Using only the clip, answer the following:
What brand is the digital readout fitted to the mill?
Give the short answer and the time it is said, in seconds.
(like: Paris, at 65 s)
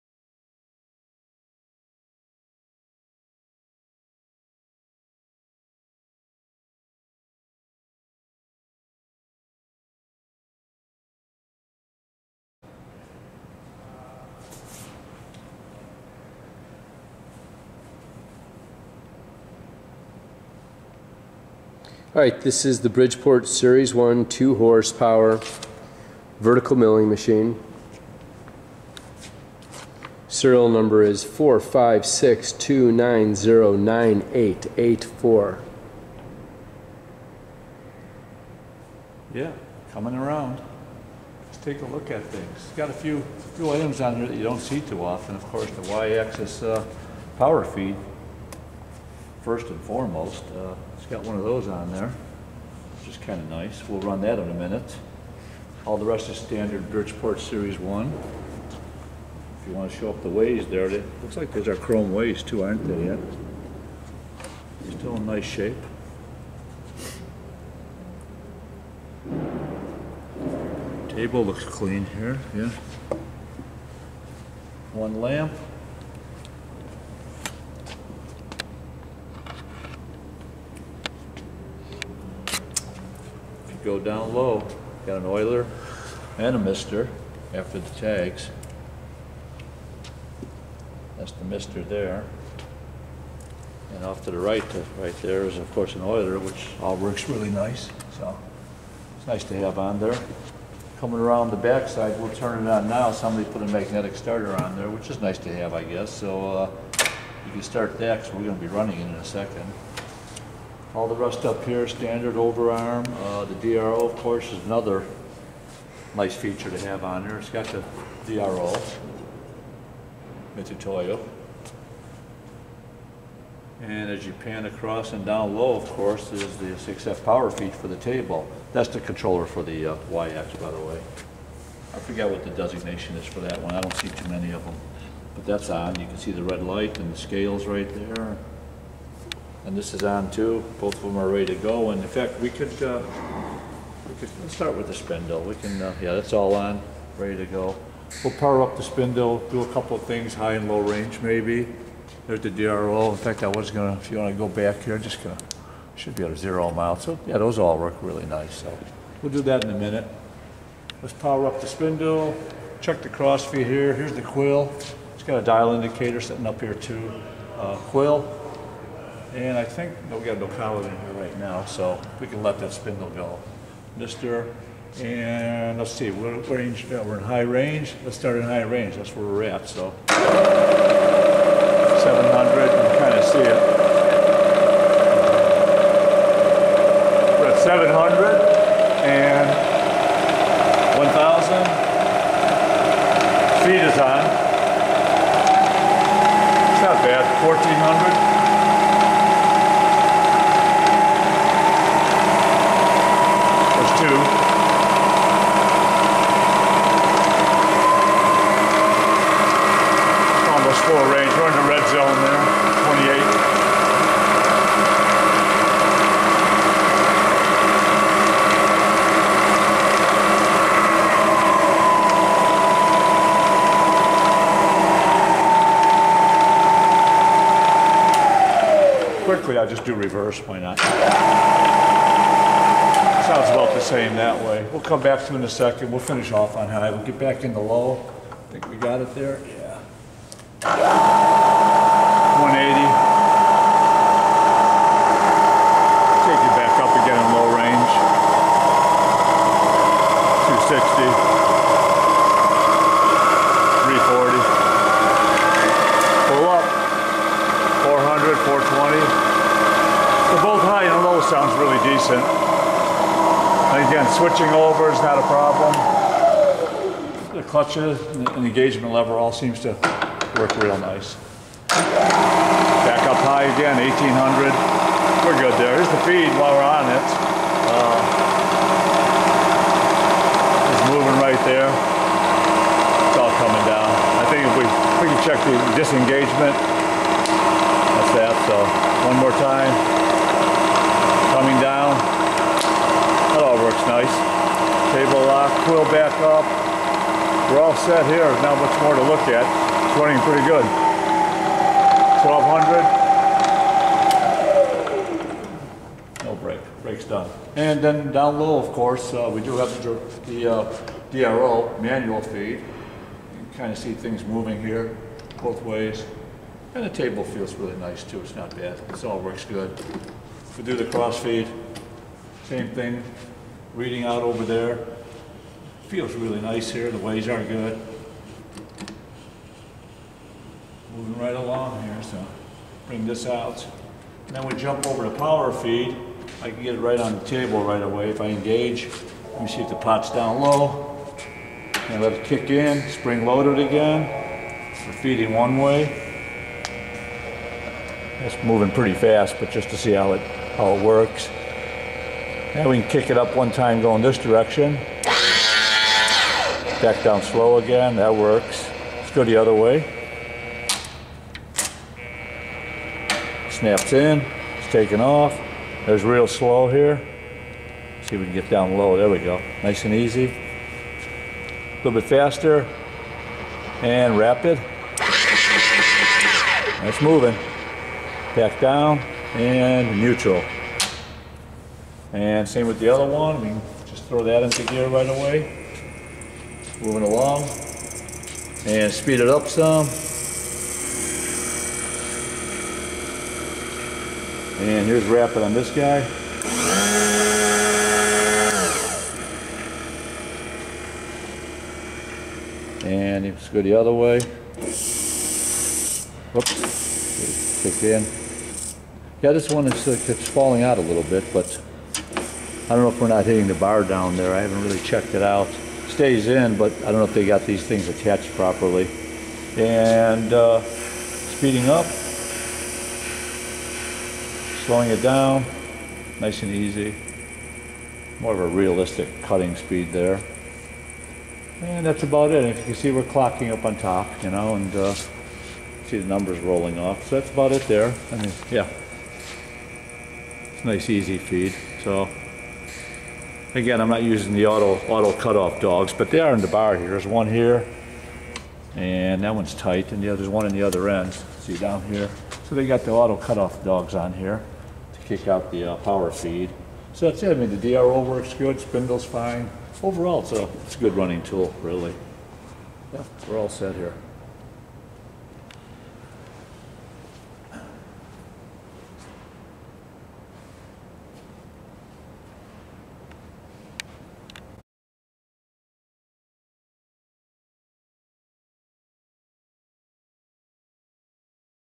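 Mitsutoyo, at 120 s.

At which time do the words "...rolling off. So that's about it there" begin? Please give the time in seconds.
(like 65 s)
436 s.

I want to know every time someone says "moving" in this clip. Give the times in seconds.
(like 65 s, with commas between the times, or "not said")
280 s, 314 s, 330 s, 348 s, 377 s, 386 s.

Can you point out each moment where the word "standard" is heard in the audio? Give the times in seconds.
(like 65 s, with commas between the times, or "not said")
56 s, 111 s.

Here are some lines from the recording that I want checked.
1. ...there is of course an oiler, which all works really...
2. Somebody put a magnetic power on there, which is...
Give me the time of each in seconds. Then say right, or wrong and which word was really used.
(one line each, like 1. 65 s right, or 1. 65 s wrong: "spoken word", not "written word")
1. 95 s right
2. 103 s wrong: "starter", not "power".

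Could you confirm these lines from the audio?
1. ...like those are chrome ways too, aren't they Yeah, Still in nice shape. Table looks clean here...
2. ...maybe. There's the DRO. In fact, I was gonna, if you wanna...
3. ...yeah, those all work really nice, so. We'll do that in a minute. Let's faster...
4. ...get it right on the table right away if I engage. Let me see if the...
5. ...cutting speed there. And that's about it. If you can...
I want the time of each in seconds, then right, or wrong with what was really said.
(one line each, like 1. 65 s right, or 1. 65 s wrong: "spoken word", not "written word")
1. 61 s right
2. 151 s right
3. 157 s wrong: "power", not "faster"
4. 336 s right
5. 429 s right.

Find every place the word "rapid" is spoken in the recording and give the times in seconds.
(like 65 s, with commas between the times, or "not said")
374 s, 395 s.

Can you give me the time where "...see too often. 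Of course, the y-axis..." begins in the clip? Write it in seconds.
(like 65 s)
44 s.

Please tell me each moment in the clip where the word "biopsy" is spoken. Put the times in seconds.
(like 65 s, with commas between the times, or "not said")
not said.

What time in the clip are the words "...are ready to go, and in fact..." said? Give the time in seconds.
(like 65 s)
141 s.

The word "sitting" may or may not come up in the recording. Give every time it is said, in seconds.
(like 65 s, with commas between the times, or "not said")
166 s.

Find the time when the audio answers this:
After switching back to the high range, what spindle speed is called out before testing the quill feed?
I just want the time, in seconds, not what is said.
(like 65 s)
273 s.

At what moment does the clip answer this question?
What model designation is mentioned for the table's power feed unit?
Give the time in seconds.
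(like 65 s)
126 s.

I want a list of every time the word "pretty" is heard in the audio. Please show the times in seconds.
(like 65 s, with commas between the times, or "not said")
300 s, 348 s.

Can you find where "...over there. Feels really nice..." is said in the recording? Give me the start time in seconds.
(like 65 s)
324 s.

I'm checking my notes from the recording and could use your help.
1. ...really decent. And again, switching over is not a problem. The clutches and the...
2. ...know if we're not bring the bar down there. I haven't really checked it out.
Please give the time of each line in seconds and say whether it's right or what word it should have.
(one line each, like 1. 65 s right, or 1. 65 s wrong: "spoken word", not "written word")
1. 261 s right
2. 412 s wrong: "hitting", not "bring".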